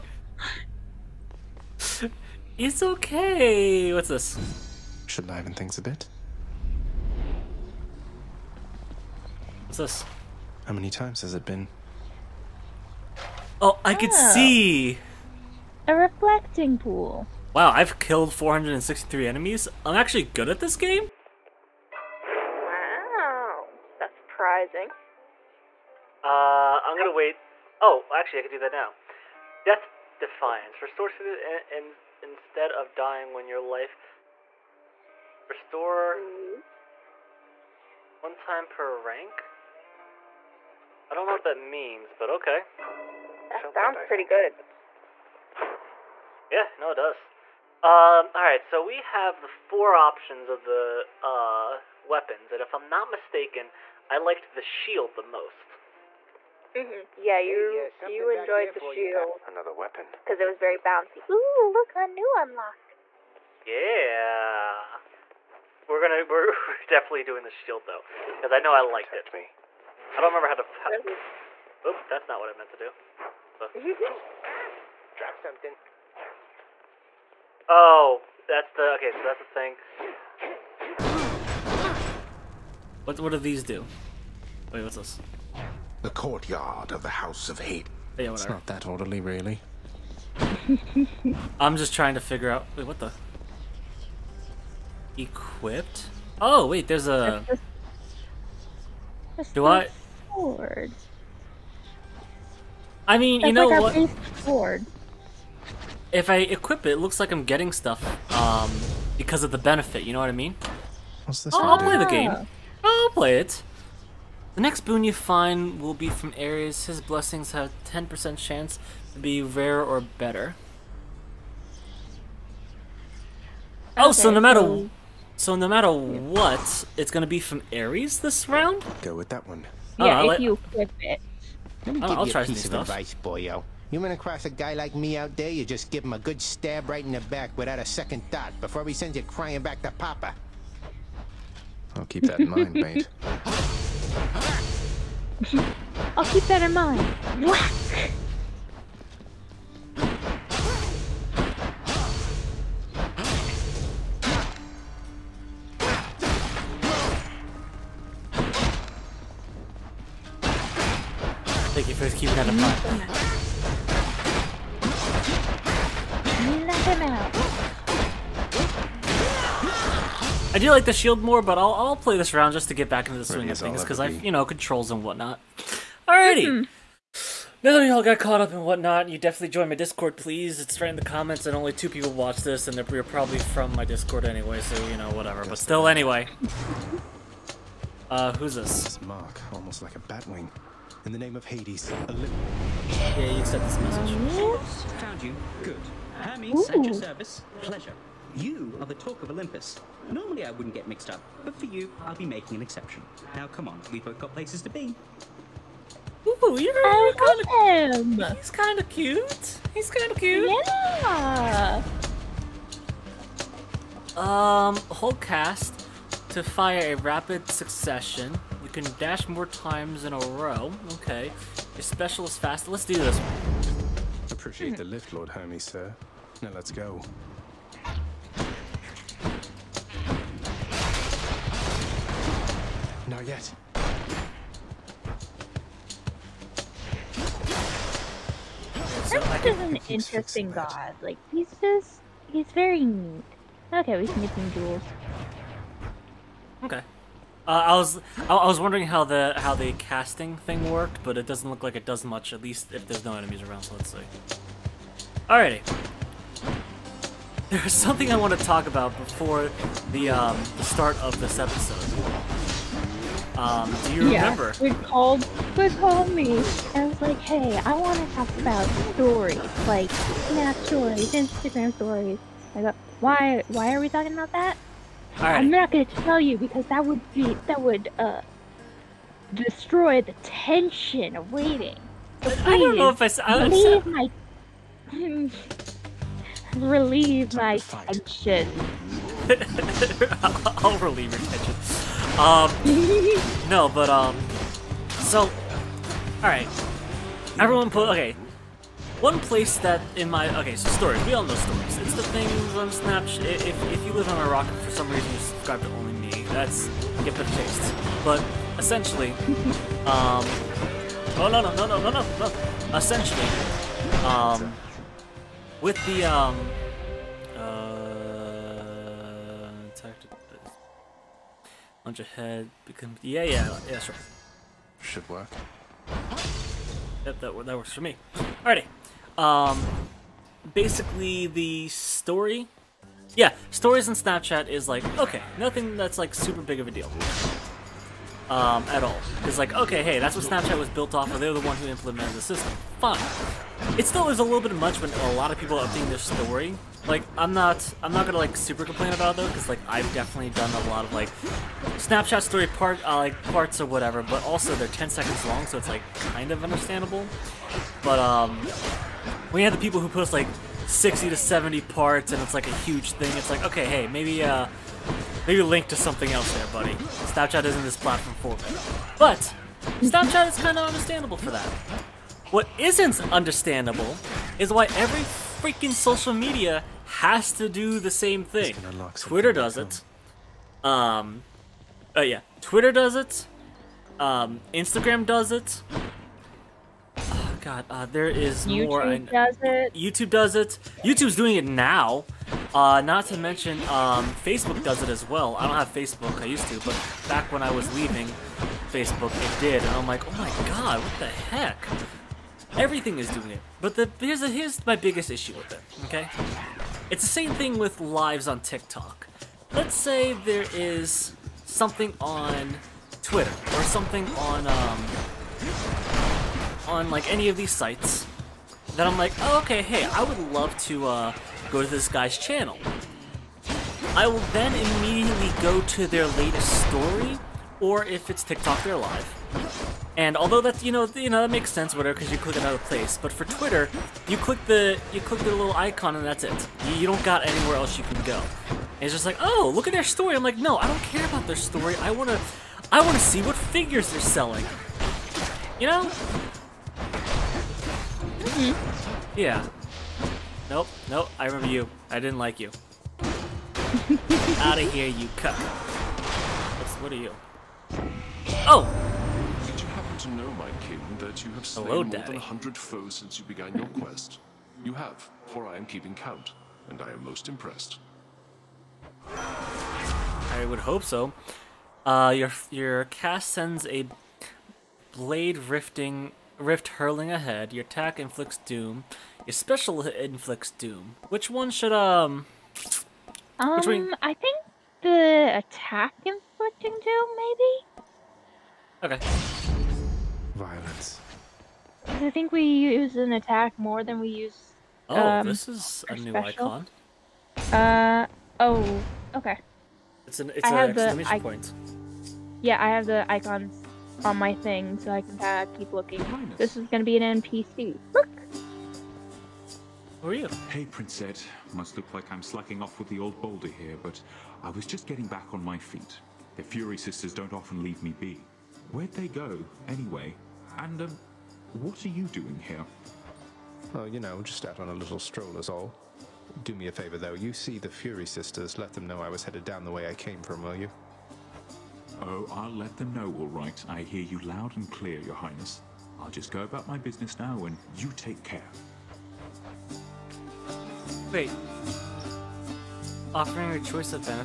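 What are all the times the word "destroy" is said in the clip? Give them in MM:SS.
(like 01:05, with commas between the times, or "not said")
04:39.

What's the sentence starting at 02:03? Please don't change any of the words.
Okay, oh, so no matter so, so no matter what, it's gonna be from Ares this round.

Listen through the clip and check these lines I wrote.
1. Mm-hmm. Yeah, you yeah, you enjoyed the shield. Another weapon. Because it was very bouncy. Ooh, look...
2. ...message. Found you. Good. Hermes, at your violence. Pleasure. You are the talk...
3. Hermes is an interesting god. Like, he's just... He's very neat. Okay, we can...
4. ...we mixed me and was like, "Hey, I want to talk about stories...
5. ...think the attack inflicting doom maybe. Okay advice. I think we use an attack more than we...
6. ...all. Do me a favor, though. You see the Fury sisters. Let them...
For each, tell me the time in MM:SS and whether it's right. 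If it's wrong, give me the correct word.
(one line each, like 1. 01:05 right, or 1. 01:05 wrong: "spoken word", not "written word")
1. 00:56 right
2. 03:13 wrong: "service", not "violence"
3. 03:58 right
4. 04:25 wrong: "called", not "mixed"
5. 08:04 wrong: "violence", not "advice"
6. 08:45 right.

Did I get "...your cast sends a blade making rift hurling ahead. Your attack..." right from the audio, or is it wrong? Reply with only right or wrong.
wrong.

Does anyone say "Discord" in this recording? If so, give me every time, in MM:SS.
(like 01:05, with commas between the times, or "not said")
02:59, 03:03.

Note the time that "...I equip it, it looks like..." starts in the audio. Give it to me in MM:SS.
01:46.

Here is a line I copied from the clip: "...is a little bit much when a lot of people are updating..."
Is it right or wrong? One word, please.
right.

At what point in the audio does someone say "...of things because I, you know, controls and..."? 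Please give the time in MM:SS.
02:53.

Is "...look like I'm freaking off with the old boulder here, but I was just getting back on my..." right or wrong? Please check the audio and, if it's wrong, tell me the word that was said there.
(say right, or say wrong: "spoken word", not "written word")
wrong: "slacking", not "freaking".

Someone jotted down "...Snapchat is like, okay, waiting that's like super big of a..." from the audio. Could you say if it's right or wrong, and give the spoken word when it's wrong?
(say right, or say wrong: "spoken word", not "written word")
wrong: "nothing", not "waiting".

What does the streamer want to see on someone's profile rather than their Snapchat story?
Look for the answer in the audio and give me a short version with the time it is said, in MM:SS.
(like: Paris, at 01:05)
figures they're selling, at 07:23.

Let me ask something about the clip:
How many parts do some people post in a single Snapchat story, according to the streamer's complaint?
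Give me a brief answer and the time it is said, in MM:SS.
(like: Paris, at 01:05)
60 to 70, at 06:00.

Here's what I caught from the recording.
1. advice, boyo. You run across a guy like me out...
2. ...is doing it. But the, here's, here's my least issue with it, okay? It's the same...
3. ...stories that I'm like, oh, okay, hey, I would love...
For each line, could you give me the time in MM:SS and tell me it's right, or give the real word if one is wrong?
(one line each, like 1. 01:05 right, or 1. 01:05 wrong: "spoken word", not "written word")
1. 02:12 right
2. 06:42 wrong: "biggest", not "least"
3. 06:57 wrong: "sites", not "stories".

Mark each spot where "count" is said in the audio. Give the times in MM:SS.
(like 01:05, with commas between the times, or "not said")
07:45.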